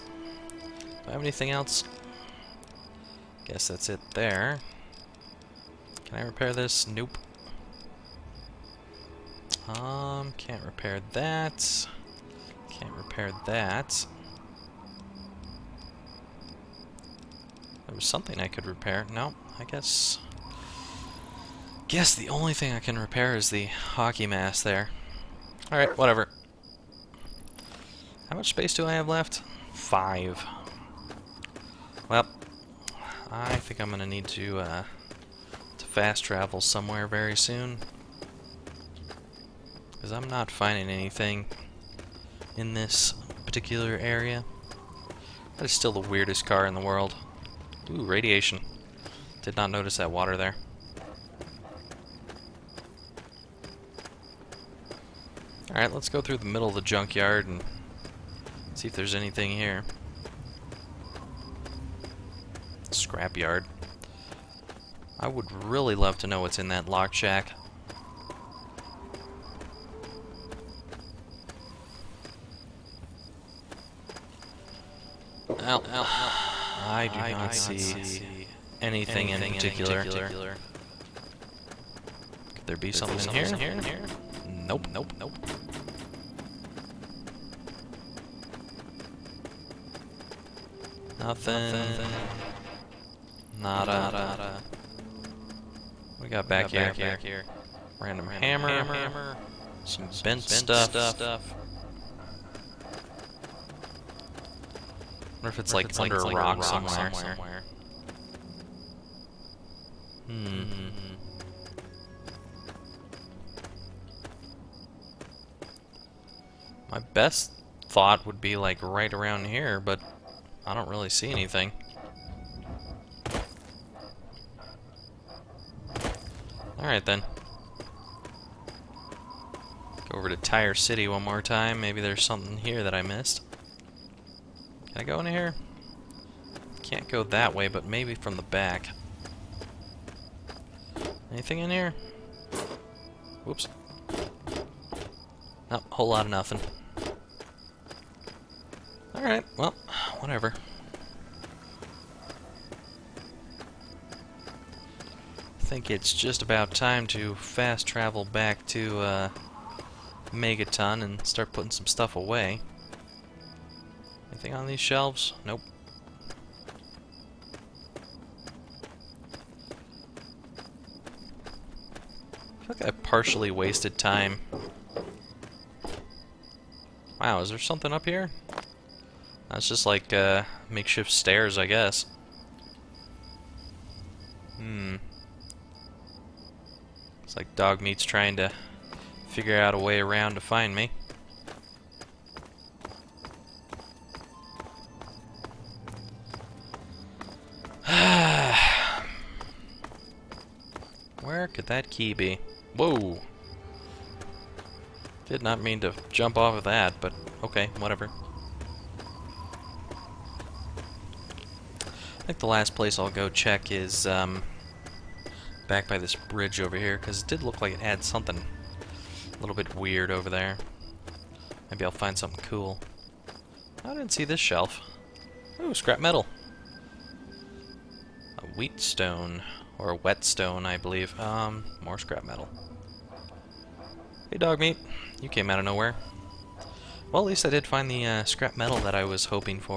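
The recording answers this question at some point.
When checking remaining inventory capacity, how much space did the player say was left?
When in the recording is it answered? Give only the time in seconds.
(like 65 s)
29 s.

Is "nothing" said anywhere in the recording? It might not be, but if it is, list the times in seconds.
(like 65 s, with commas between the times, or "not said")
91 s, 146 s.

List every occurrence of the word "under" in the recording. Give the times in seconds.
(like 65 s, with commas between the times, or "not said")
105 s.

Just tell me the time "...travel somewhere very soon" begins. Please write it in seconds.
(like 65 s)
36 s.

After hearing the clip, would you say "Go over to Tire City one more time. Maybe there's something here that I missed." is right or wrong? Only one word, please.
right.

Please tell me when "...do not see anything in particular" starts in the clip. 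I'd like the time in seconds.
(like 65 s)
77 s.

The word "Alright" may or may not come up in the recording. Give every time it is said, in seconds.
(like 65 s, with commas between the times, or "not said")
25 s, 55 s, 126 s, 149 s.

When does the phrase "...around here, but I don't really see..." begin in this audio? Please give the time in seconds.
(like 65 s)
119 s.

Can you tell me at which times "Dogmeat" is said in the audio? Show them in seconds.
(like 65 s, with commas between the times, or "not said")
187 s, 234 s.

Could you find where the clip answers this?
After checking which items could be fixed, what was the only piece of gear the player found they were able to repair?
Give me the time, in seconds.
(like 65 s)
23 s.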